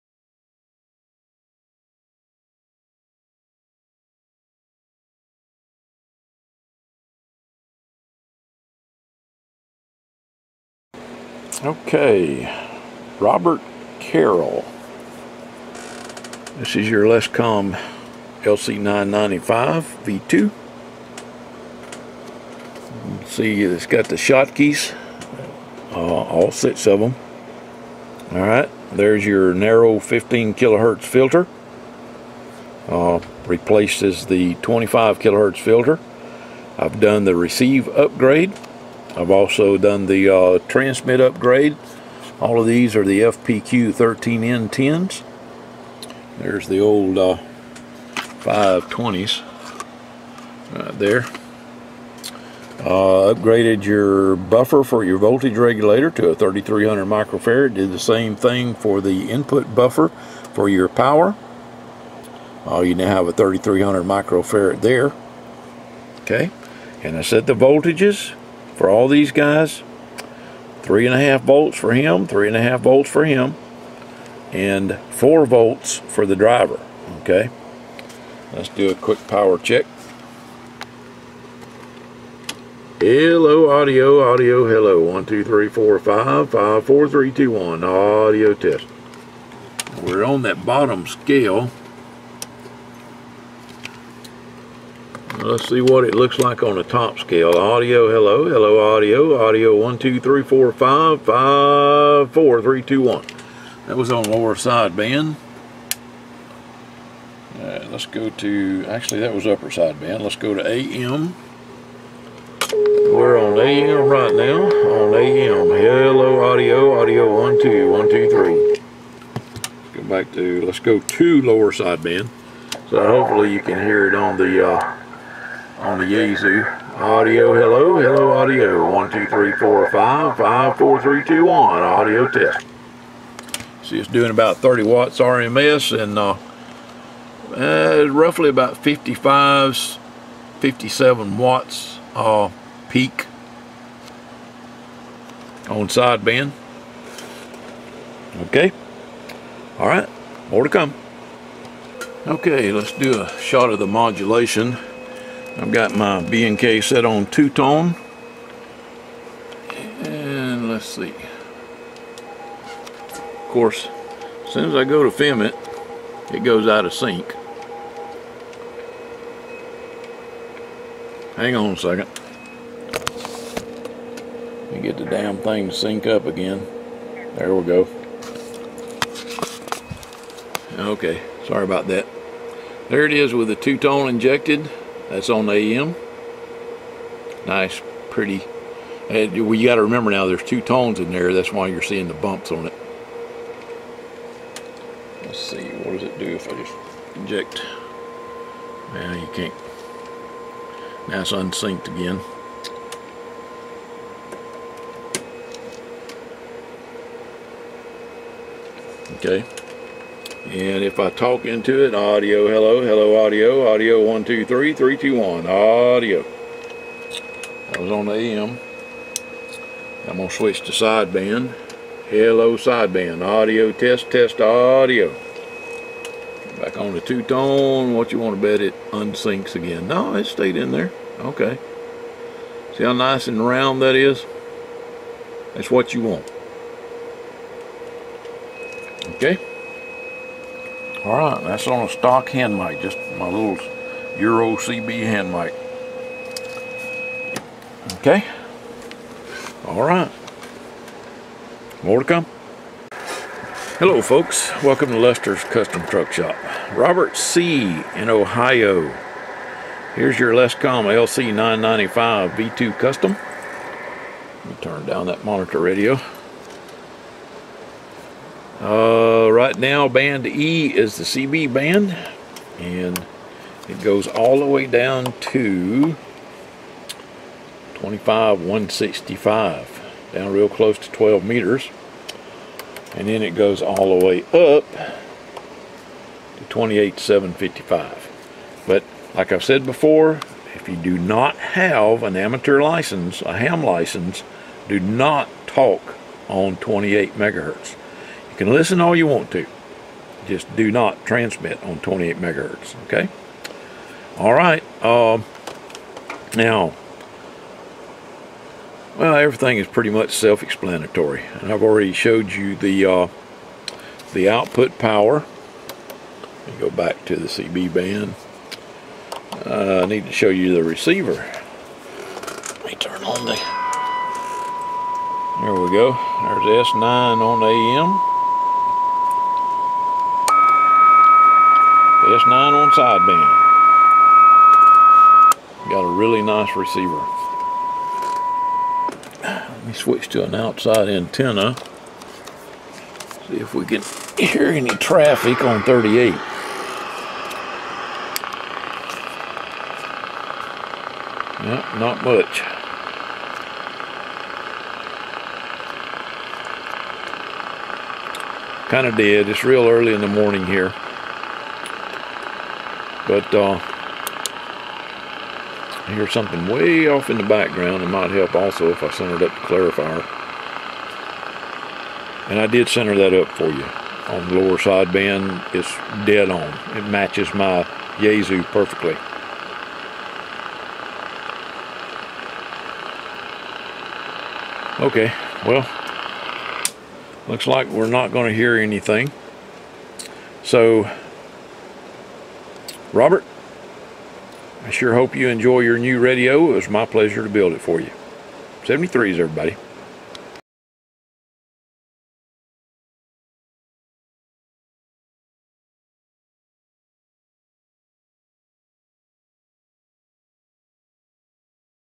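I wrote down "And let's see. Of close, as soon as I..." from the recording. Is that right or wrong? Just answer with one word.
wrong.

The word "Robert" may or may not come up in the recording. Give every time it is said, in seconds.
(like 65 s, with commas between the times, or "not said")
13 s, 256 s, 392 s.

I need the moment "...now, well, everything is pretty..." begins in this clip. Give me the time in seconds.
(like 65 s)
306 s.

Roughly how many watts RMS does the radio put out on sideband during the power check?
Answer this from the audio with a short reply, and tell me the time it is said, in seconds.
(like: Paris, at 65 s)
30 watts, at 134 s.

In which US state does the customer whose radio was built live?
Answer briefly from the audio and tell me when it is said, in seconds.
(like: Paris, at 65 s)
Ohio, at 258 s.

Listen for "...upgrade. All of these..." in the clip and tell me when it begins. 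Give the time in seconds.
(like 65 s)
41 s.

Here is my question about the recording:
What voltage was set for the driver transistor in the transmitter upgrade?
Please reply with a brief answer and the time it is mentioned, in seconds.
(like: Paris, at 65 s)
4 volts, at 75 s.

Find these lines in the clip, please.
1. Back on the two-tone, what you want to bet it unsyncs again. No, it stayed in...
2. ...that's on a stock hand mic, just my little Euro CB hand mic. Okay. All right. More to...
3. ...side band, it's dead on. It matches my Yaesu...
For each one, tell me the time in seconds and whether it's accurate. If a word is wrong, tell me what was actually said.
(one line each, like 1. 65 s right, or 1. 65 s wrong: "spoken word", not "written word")
1. 226 s right
2. 241 s right
3. 374 s right.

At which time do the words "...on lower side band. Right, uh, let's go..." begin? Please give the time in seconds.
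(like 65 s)
104 s.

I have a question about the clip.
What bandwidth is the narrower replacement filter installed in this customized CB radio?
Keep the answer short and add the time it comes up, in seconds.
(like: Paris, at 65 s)
15 kHz, at 29 s.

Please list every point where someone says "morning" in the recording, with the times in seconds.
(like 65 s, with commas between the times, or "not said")
360 s.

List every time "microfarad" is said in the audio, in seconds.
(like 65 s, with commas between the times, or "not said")
57 s, 64 s.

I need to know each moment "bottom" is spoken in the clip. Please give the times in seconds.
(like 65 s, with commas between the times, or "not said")
90 s.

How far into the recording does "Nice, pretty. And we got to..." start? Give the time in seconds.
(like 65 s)
187 s.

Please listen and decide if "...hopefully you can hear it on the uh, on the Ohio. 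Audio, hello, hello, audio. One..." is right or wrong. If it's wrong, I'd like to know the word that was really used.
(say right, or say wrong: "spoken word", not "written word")
wrong: "Yaesu", not "Ohio".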